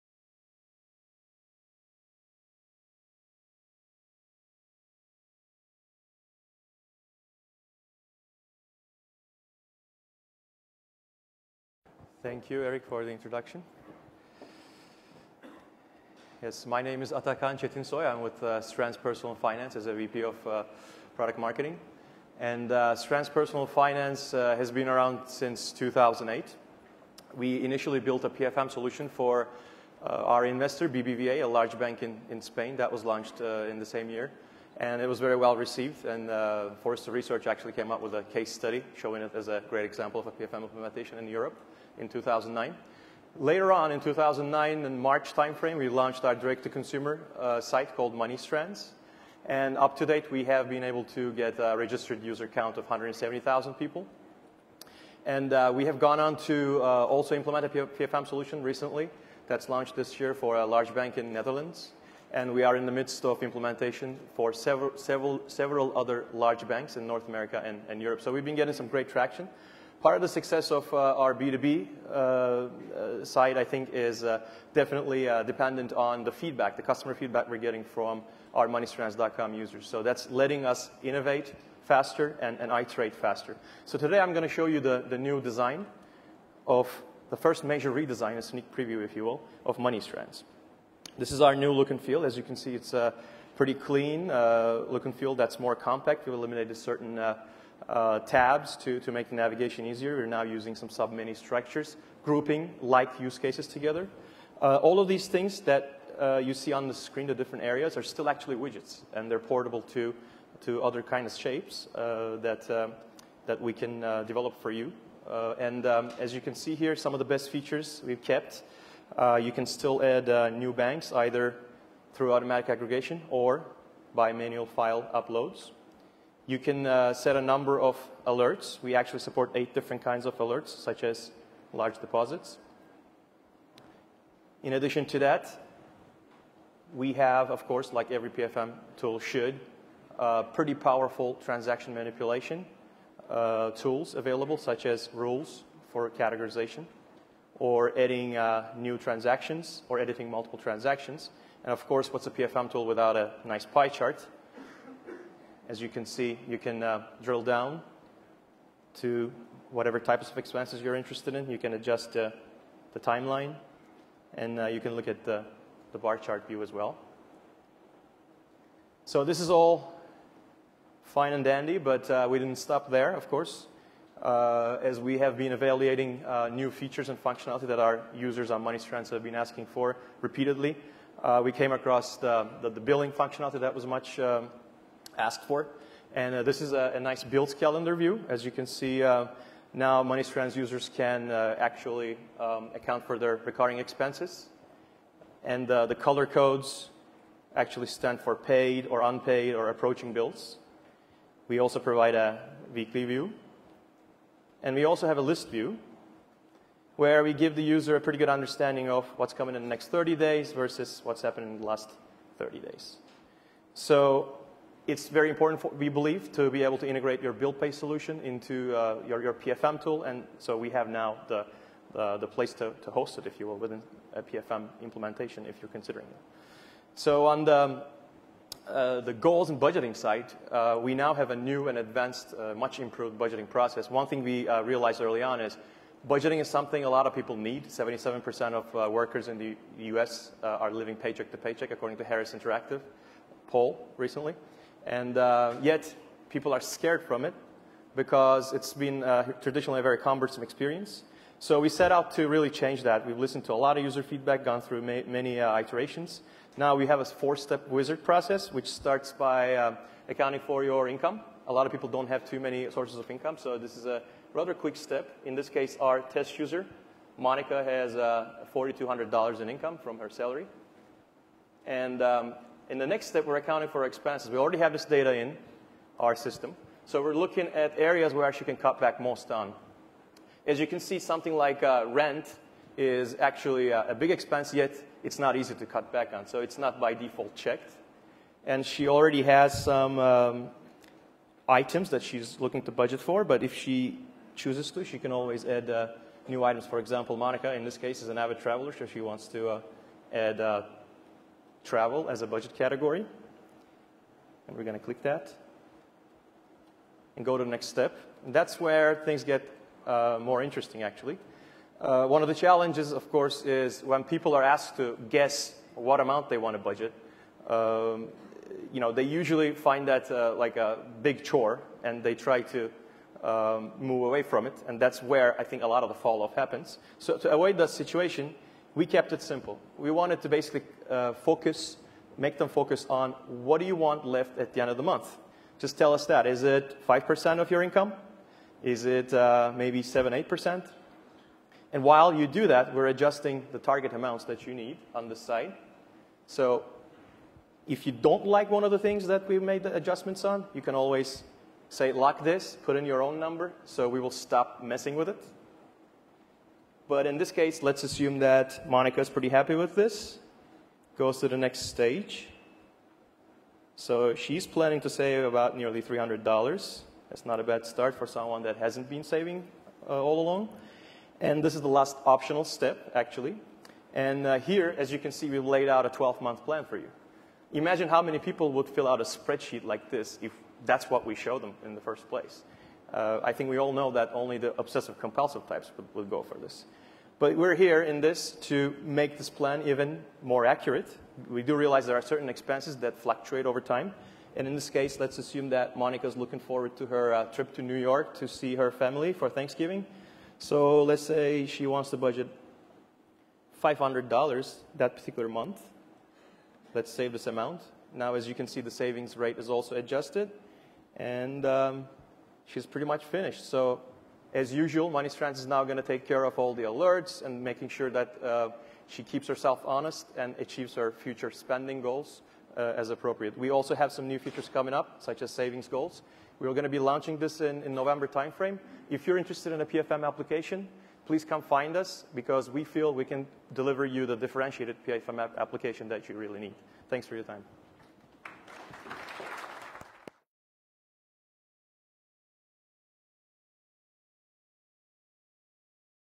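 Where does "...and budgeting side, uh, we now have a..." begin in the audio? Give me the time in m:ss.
3:49.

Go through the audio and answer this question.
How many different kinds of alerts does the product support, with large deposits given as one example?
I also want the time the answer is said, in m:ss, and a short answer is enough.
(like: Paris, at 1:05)
8, at 2:09.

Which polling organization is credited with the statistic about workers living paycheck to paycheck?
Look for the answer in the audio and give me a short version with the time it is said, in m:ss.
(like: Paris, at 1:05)
Harris Interactive, at 4:02.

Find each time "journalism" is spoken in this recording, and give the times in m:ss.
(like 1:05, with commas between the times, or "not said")
not said.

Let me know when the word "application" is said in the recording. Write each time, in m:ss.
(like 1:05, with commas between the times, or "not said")
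7:10, 7:15.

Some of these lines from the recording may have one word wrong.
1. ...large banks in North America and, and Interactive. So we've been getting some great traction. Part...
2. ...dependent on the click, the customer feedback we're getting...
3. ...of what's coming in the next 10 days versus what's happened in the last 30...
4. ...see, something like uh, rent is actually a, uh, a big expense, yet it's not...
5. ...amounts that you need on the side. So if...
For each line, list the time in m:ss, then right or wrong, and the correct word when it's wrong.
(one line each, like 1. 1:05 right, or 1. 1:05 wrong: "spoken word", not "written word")
1. 1:06 wrong: "Europe", not "Interactive"
2. 1:15 wrong: "feedback", not "click"
3. 3:28 wrong: "30", not "10"
4. 4:40 right
5. 5:43 right.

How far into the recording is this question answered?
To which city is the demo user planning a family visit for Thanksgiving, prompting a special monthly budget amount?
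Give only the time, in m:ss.
6:37.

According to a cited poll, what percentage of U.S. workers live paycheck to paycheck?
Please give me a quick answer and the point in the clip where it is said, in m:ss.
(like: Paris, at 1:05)
77%, at 3:57.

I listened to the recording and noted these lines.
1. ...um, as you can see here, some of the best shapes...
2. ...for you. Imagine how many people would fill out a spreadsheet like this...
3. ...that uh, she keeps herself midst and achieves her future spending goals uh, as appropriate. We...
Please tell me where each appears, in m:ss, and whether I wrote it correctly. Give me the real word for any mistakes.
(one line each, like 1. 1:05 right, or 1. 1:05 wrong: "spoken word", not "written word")
1. 1:55 wrong: "features", not "shapes"
2. 6:16 right
3. 6:57 wrong: "honest", not "midst".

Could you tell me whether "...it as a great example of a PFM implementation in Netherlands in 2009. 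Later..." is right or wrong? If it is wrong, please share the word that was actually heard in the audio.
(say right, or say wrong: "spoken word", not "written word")
wrong: "Europe", not "Netherlands".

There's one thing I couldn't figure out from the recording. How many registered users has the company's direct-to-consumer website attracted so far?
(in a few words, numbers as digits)
170,000.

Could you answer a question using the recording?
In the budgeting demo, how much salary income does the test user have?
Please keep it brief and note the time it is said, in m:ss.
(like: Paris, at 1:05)
$4,200, at 4:28.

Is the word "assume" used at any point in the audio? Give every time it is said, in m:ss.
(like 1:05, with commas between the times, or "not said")
5:57, 6:35.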